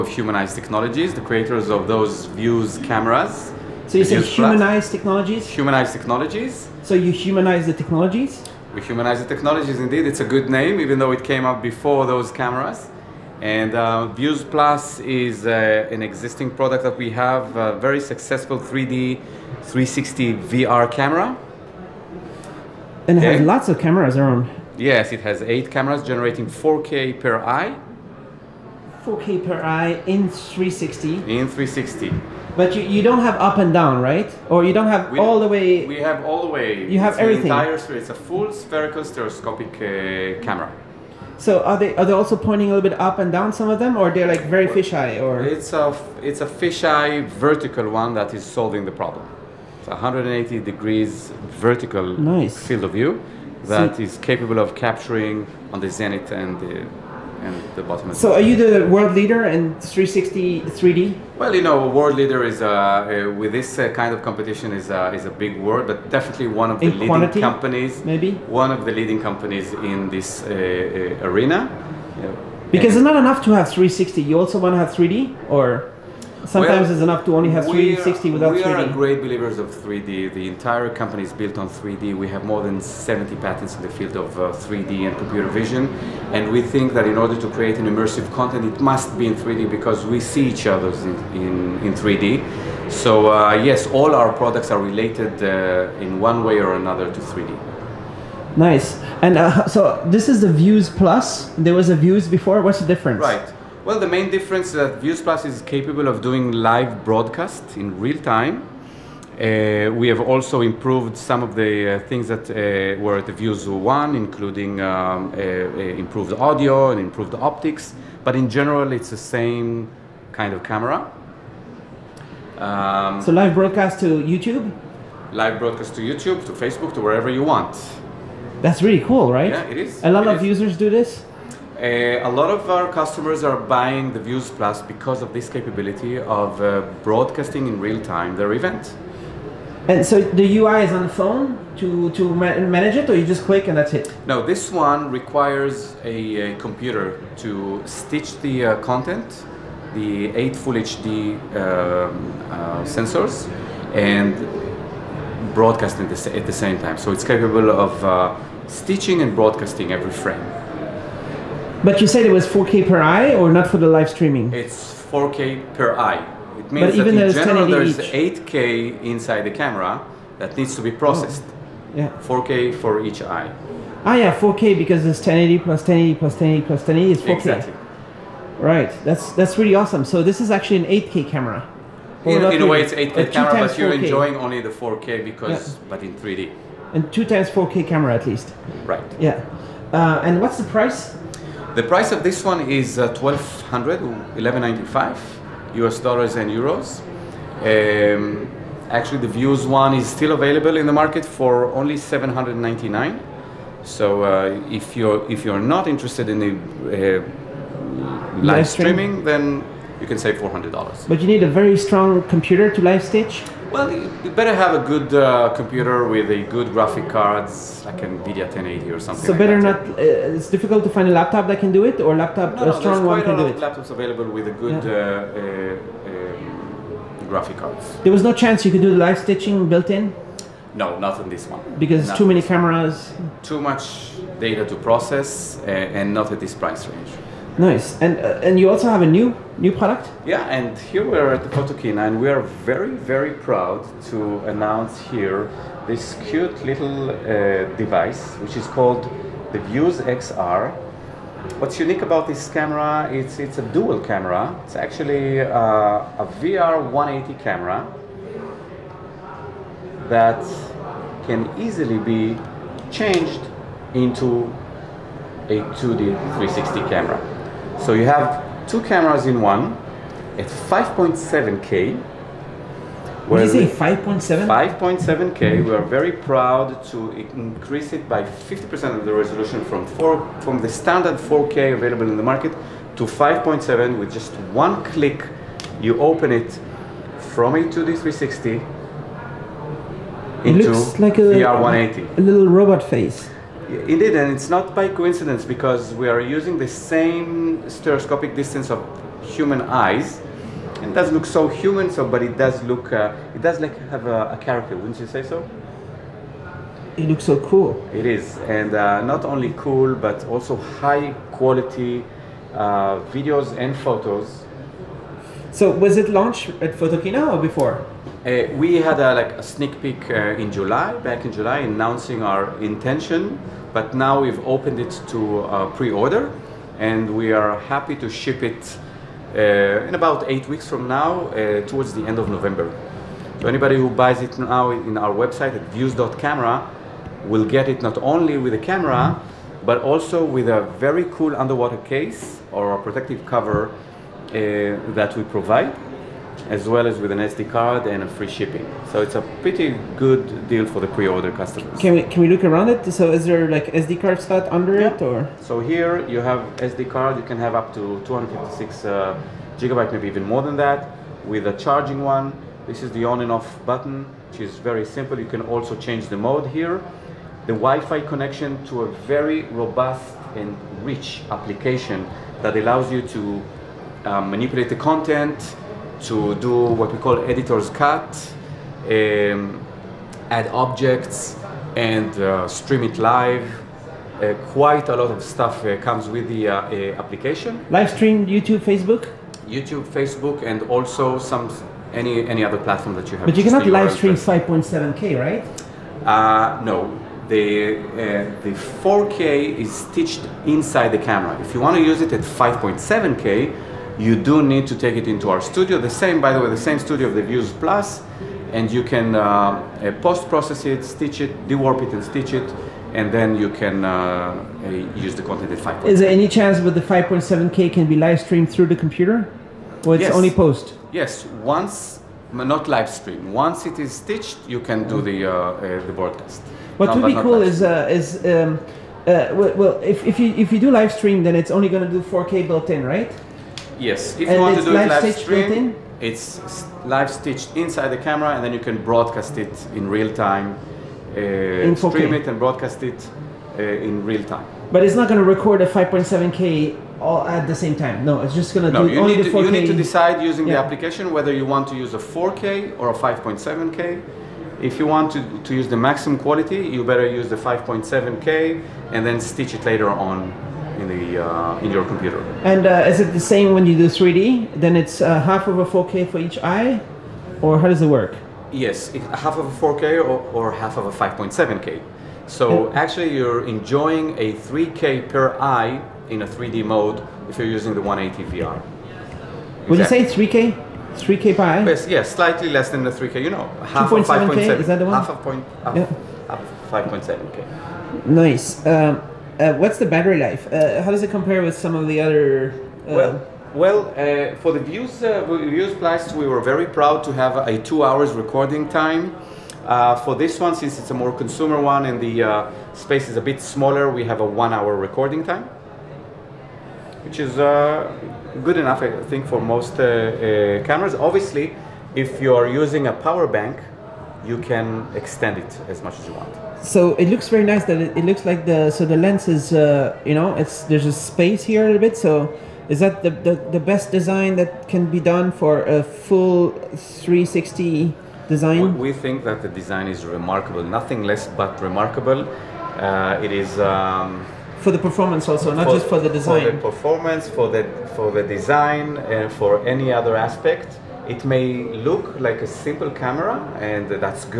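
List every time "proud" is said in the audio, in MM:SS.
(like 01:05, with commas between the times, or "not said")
04:03, 04:36, 08:16.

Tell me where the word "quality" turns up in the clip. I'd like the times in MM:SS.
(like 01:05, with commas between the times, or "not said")
05:11, 07:36.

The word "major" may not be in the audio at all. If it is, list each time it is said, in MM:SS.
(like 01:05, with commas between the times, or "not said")
not said.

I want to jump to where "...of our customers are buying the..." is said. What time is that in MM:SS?
02:12.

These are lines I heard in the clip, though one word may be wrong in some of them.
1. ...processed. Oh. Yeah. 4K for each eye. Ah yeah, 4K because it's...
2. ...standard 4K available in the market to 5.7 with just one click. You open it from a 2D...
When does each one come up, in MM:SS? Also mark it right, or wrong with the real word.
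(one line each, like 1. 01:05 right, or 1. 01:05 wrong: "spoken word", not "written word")
1. 02:50 right
2. 04:40 right.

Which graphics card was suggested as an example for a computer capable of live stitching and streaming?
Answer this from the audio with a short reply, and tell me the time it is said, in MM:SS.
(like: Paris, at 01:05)
NVIDIA 1080, at 03:37.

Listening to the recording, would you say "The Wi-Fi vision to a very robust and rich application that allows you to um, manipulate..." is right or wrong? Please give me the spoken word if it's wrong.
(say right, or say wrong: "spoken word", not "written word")
wrong: "connection", not "vision".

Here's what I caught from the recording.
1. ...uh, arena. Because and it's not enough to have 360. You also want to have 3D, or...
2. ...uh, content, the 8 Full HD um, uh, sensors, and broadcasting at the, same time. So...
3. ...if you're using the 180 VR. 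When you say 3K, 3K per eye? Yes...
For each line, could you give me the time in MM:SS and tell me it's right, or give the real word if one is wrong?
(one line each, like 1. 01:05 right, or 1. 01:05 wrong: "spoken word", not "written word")
1. 01:10 right
2. 02:28 right
3. 07:57 right.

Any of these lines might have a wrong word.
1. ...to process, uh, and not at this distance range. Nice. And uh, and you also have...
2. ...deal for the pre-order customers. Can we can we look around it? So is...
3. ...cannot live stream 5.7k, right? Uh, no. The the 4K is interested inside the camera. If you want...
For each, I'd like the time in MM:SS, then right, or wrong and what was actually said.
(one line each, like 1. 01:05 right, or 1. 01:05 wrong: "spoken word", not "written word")
1. 03:54 wrong: "price", not "distance"
2. 05:50 right
3. 06:33 wrong: "stitched", not "interested".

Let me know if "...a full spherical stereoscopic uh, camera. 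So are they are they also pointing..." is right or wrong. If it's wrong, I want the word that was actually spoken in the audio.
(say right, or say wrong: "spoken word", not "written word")
right.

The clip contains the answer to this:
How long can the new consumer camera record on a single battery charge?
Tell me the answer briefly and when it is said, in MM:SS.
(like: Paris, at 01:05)
one hour, at 08:24.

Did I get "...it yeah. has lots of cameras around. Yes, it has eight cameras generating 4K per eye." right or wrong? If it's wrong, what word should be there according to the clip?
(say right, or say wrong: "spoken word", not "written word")
right.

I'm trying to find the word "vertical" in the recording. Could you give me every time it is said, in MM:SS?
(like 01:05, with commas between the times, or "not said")
00:47, 00:51.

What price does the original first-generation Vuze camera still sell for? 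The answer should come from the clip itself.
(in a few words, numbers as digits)
799.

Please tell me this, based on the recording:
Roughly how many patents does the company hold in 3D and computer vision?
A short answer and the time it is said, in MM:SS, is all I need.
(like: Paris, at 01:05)
more than 70, at 01:22.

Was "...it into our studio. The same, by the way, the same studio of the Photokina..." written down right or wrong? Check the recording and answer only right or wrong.
wrong.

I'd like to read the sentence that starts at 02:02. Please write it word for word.
Um, so live broadcast to YouTube?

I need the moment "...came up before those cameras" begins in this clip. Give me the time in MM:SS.
00:11.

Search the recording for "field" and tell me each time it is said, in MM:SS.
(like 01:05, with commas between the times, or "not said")
00:52, 01:23.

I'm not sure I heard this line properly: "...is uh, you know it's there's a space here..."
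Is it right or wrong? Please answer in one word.
right.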